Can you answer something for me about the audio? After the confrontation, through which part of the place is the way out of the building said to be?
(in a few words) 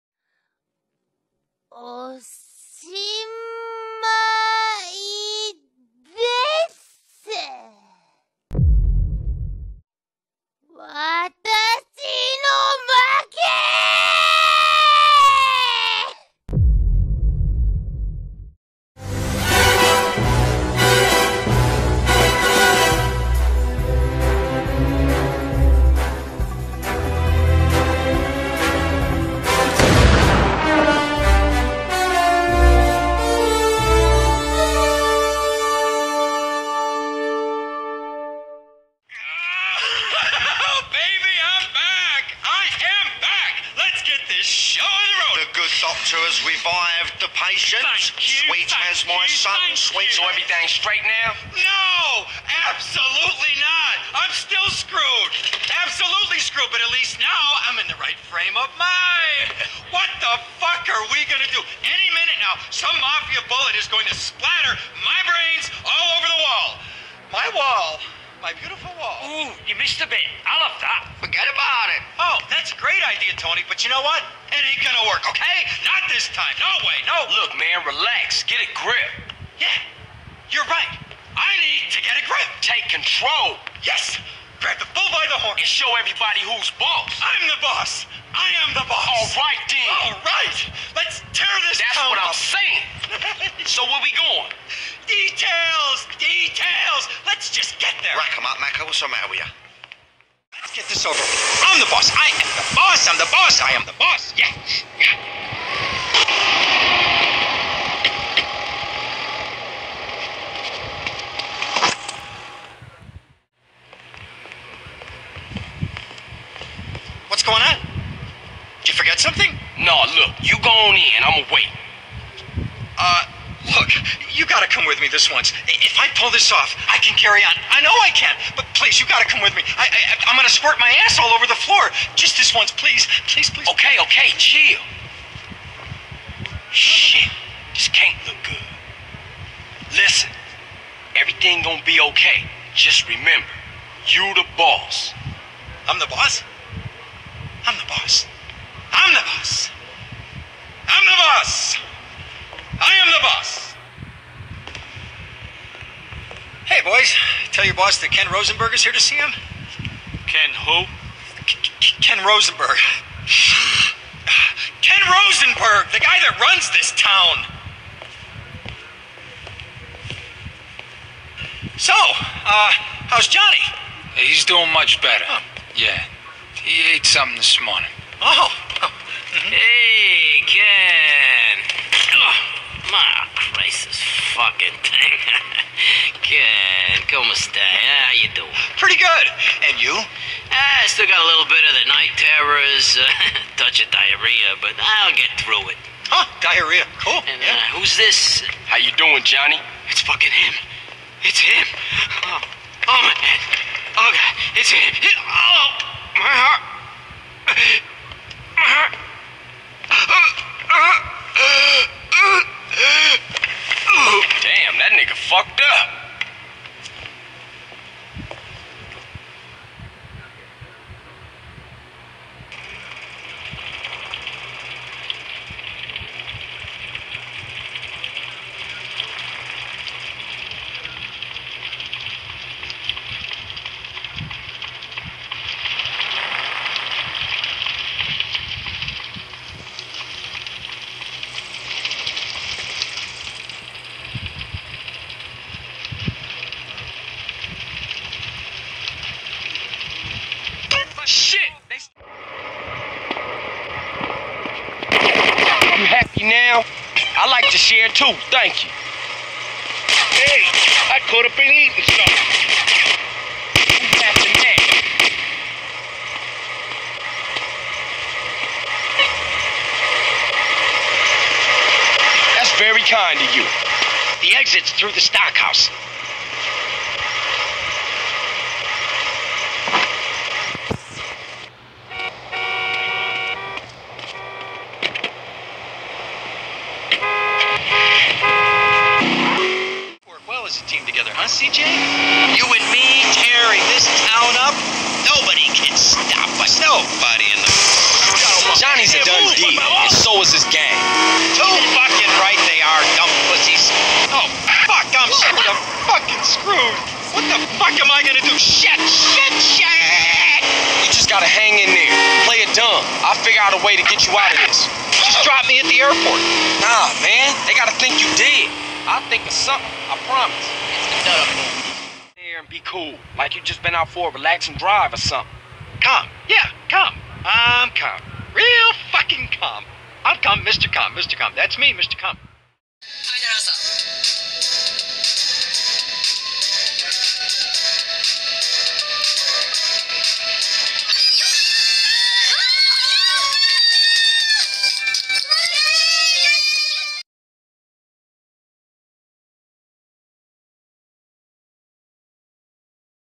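The stockhouse.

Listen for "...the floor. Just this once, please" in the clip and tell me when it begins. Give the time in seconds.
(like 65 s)
131 s.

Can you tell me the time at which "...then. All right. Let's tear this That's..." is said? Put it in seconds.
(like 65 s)
89 s.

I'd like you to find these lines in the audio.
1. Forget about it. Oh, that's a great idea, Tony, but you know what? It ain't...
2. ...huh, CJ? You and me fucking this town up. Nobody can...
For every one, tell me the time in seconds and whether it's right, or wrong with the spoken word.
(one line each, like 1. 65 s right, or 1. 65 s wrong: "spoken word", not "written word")
1. 71 s right
2. 291 s wrong: "tearing", not "fucking".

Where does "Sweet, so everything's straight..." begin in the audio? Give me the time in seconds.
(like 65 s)
49 s.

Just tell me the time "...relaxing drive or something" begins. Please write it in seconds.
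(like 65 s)
324 s.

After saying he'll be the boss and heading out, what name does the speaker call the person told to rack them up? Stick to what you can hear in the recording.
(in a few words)
Mako.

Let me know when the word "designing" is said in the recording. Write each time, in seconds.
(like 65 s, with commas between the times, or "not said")
not said.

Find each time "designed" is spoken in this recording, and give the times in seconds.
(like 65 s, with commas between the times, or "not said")
not said.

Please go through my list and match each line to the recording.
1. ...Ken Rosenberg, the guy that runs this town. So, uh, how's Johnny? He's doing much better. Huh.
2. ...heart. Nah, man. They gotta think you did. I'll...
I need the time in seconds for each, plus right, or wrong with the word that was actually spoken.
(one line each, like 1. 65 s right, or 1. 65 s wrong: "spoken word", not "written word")
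1. 164 s right
2. 315 s wrong: "airport", not "heart".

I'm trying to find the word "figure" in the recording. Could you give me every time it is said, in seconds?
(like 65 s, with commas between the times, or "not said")
313 s.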